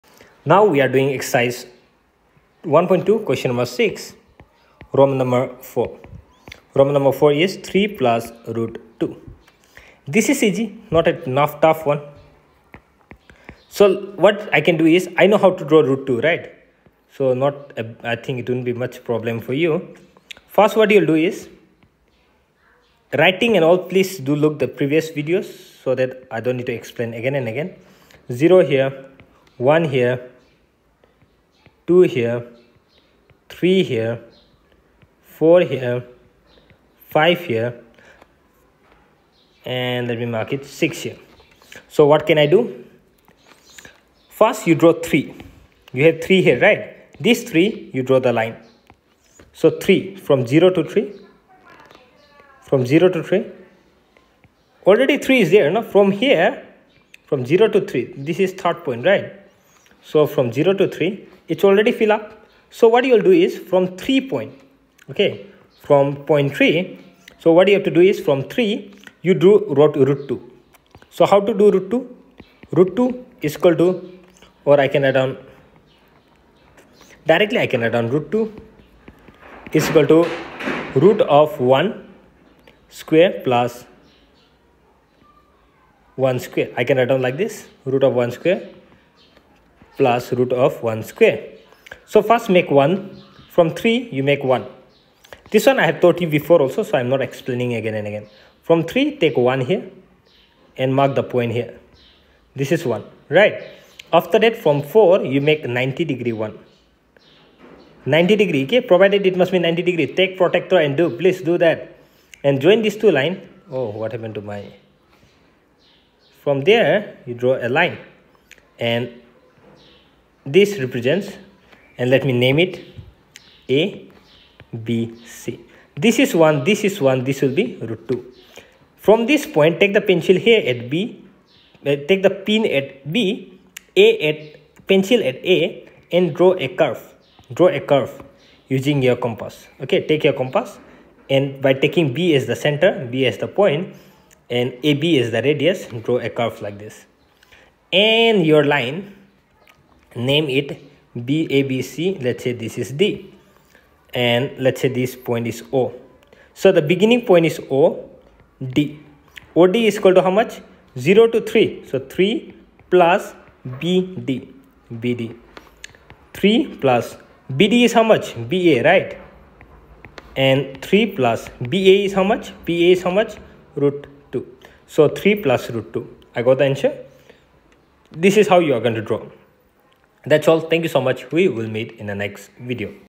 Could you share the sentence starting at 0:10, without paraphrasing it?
This is easy not a enough tough one.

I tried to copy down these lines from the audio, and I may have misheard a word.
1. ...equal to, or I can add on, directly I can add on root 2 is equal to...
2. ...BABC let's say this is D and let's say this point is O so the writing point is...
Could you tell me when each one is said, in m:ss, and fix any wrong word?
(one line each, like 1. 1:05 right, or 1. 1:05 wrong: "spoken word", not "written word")
1. 1:13 right
2. 2:31 wrong: "beginning", not "writing".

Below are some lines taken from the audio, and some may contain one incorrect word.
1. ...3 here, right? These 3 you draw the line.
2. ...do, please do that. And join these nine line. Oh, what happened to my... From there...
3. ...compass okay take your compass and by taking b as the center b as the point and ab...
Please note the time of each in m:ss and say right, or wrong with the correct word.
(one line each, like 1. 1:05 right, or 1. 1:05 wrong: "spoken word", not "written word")
1. 0:46 right
2. 1:50 wrong: "two", not "nine"
3. 2:19 right.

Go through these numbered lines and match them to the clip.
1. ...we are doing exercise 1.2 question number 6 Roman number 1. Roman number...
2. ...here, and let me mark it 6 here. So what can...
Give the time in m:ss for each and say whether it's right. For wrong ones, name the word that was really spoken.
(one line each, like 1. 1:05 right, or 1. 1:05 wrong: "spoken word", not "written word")
1. 0:00 wrong: "4", not "1"
2. 0:37 right.